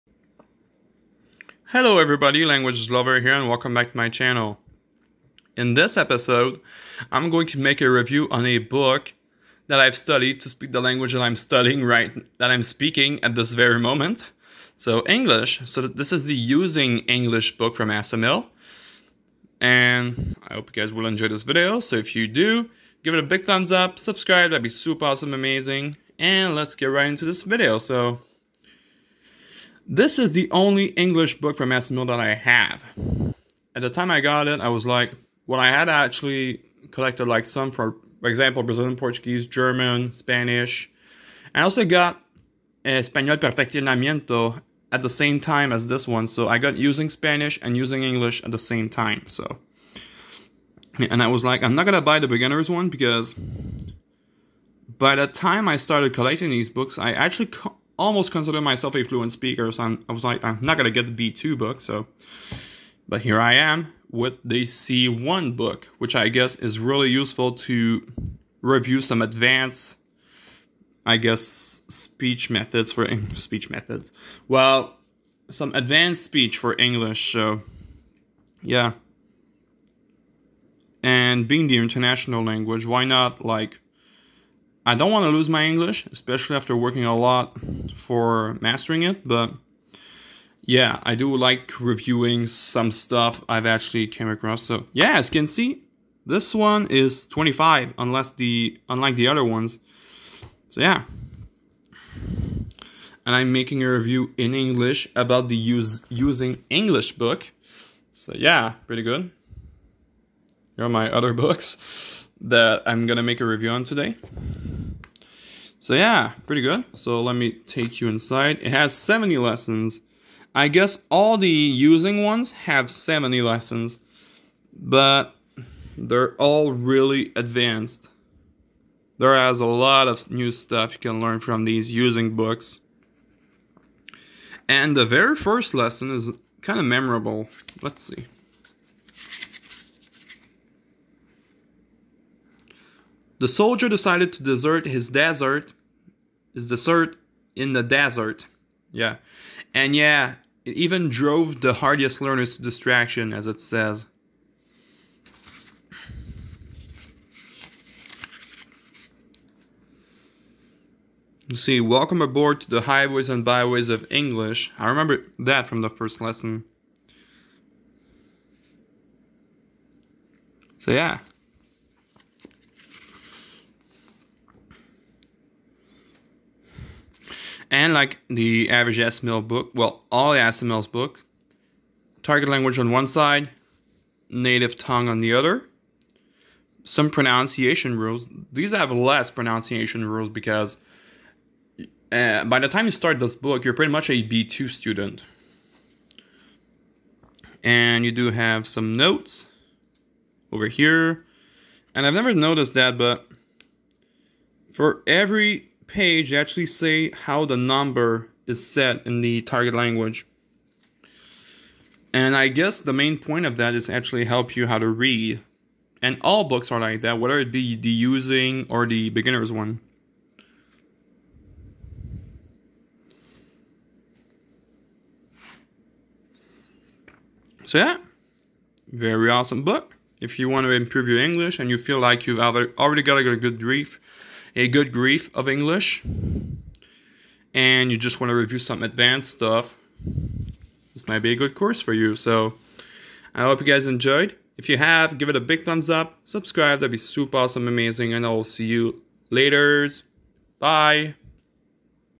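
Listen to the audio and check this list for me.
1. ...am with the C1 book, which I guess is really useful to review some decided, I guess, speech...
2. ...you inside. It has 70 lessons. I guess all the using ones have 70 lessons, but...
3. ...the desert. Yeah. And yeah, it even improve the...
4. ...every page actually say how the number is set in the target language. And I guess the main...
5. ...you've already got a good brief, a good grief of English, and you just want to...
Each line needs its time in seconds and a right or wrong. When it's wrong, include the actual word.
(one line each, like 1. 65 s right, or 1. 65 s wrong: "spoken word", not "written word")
1. 63 s wrong: "advanced", not "decided"
2. 118 s right
3. 147 s wrong: "drove", not "improve"
4. 205 s right
5. 232 s right.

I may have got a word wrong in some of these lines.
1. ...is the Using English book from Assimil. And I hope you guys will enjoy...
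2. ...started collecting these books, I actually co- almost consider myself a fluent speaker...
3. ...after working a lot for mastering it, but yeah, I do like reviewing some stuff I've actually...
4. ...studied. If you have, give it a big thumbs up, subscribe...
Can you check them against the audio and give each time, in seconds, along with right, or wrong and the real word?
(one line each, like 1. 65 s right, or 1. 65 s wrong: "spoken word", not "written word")
1. 16 s right
2. 55 s right
3. 86 s right
4. 243 s wrong: "enjoyed", not "studied".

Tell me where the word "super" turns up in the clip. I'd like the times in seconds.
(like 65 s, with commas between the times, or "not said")
24 s, 246 s.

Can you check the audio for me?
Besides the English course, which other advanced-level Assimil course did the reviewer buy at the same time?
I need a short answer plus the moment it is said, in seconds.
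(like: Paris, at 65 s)
Espanol Perfeccionamiento, at 42 s.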